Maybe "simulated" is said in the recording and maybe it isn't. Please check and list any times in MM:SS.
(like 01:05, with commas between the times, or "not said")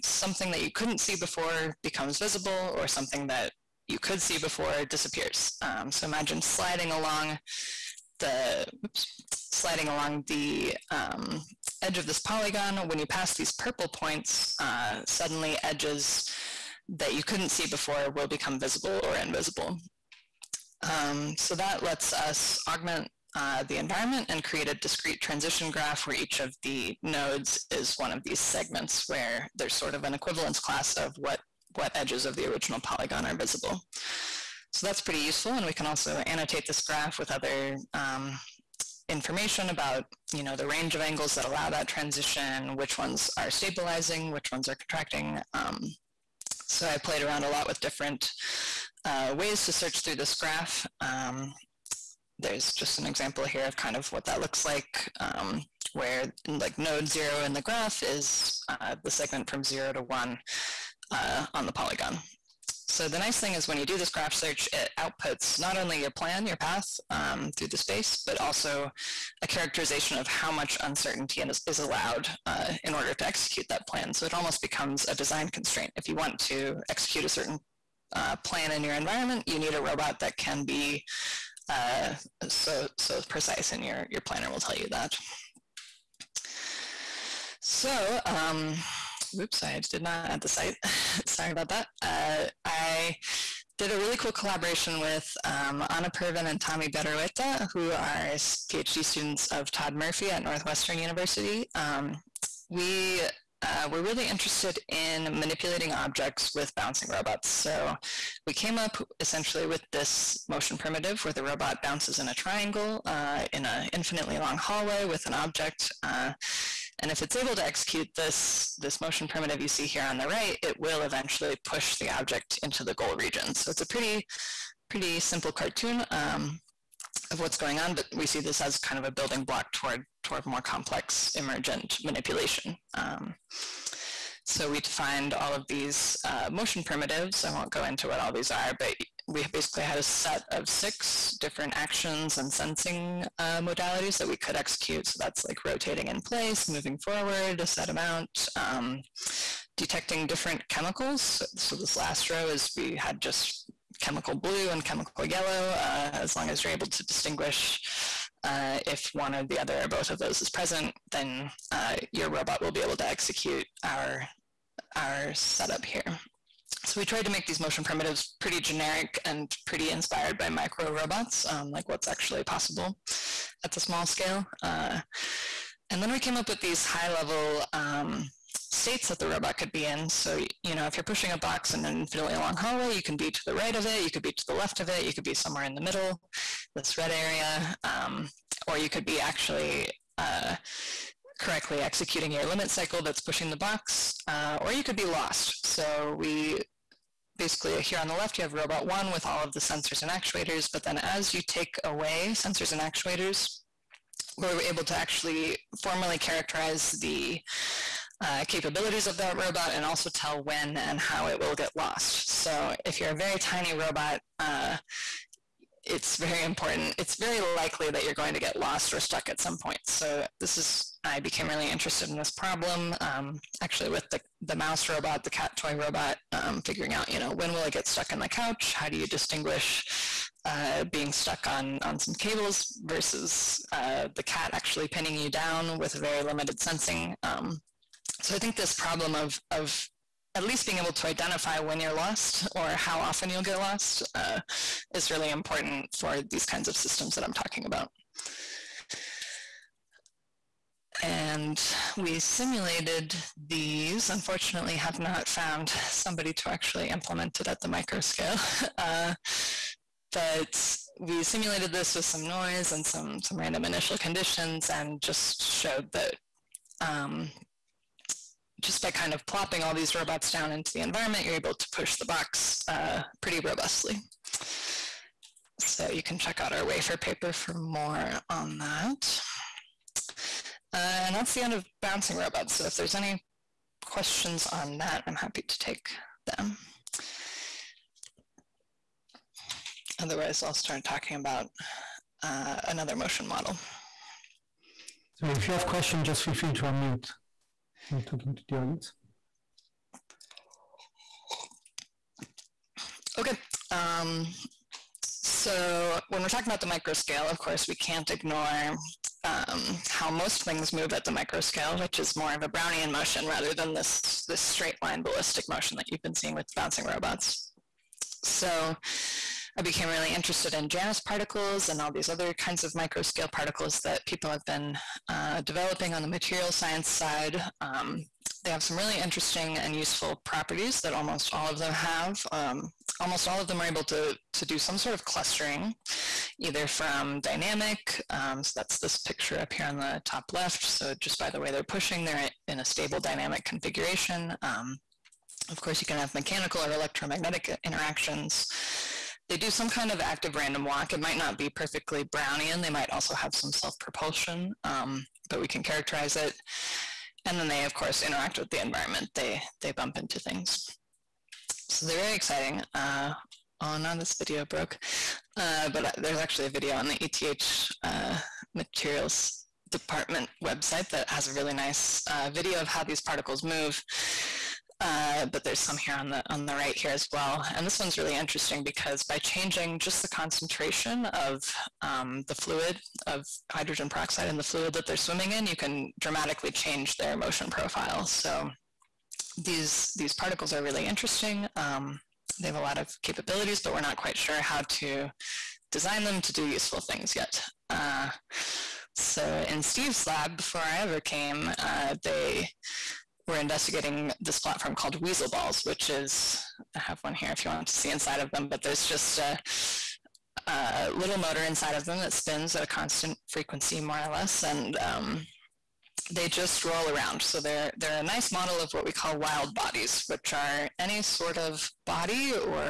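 04:12, 04:21.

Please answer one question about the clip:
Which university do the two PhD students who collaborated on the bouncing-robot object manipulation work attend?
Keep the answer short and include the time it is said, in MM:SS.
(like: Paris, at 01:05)
Northwestern University, at 01:40.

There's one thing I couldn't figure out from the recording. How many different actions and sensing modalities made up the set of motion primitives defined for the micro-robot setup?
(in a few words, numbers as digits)
6.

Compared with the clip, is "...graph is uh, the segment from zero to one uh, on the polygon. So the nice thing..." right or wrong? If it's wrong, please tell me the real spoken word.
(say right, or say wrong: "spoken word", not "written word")
right.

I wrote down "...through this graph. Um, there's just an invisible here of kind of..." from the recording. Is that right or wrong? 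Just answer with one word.
wrong.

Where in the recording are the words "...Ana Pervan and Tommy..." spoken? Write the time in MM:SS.
01:35.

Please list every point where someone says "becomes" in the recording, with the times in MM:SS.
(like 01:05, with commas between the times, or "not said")
00:01, 00:18, 01:14.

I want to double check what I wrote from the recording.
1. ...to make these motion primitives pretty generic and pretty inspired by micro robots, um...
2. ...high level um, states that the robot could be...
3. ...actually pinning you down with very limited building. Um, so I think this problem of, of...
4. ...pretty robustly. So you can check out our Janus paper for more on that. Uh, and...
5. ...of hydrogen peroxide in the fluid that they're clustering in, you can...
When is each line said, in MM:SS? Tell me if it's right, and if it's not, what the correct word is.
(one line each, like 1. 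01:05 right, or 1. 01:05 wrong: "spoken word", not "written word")
1. 02:47 right
2. 02:56 right
3. 03:54 wrong: "sensing", not "building"
4. 04:33 wrong: "WAFR", not "Janus"
5. 06:23 wrong: "swimming", not "clustering".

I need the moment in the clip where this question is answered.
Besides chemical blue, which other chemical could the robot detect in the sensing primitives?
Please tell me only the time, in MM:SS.
02:34.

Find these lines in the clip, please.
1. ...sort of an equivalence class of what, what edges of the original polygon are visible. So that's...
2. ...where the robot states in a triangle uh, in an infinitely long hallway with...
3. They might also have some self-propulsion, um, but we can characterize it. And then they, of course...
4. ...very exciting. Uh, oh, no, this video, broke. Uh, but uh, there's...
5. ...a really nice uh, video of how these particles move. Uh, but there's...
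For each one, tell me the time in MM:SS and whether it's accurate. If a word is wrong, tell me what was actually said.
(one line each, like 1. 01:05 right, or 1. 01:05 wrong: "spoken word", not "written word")
1. 00:29 right
2. 01:51 wrong: "bounces", not "states"
3. 05:52 right
4. 06:01 right
5. 06:11 right.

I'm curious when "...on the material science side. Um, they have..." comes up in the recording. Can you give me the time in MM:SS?
05:25.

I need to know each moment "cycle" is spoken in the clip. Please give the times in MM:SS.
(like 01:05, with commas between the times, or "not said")
03:12.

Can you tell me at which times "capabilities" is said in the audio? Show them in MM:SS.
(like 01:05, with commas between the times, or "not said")
03:28, 06:33.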